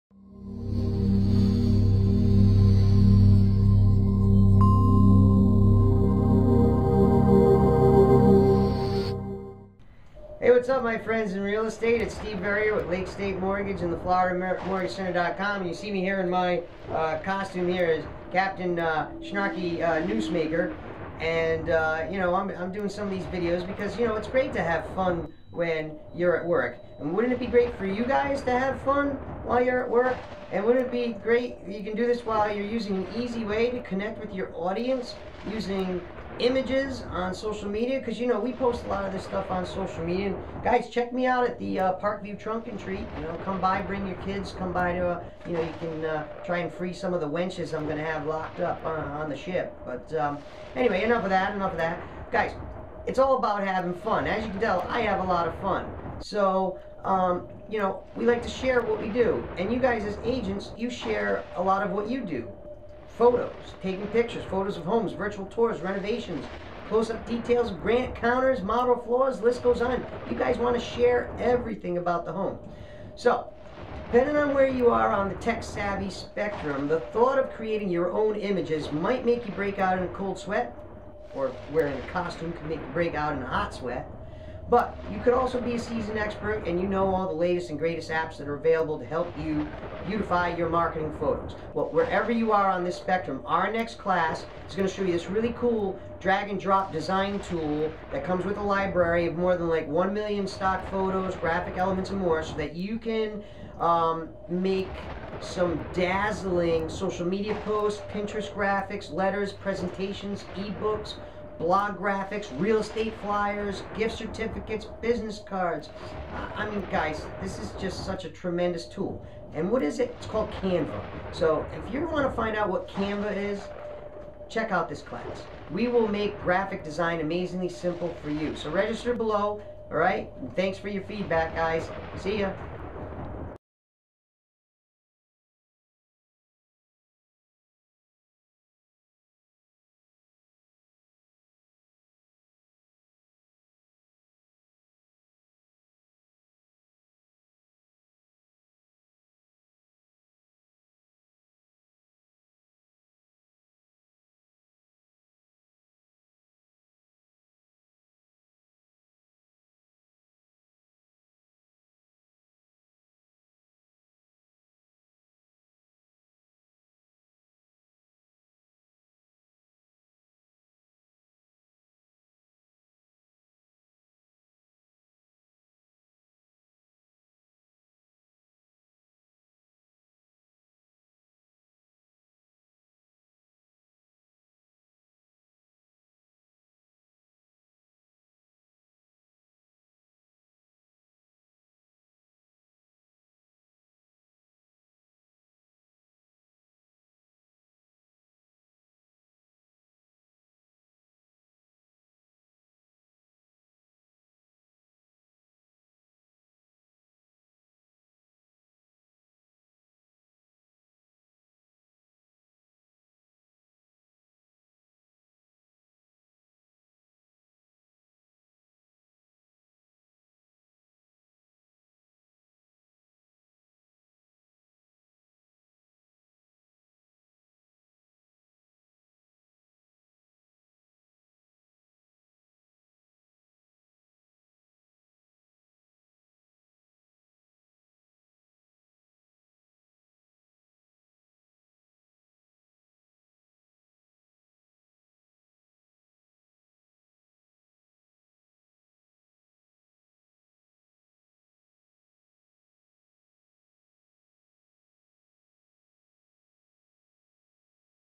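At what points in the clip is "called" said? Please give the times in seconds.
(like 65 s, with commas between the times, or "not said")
120 s.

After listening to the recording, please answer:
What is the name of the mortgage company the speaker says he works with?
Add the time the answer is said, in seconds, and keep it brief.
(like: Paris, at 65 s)
Lake State Mortgage, at 12 s.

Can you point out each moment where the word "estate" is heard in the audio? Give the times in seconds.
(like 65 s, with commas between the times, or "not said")
11 s, 112 s.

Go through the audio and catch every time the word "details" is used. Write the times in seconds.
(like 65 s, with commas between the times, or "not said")
67 s.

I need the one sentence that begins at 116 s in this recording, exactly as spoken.
I mean, guys, this is just such a tremendous tool.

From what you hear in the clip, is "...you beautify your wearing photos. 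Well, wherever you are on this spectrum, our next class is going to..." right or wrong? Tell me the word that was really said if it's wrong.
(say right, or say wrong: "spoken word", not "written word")
wrong: "marketing", not "wearing".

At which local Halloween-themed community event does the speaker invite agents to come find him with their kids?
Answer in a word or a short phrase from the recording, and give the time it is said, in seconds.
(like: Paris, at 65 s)
Parkview Trunk and Treat, at 41 s.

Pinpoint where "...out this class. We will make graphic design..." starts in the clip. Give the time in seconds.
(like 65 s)
124 s.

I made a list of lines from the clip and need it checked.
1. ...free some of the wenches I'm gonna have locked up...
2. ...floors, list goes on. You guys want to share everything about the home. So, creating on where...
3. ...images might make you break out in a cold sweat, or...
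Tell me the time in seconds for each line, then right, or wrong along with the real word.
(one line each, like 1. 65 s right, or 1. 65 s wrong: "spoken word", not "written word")
1. 46 s right
2. 69 s wrong: "depending", not "creating"
3. 78 s right.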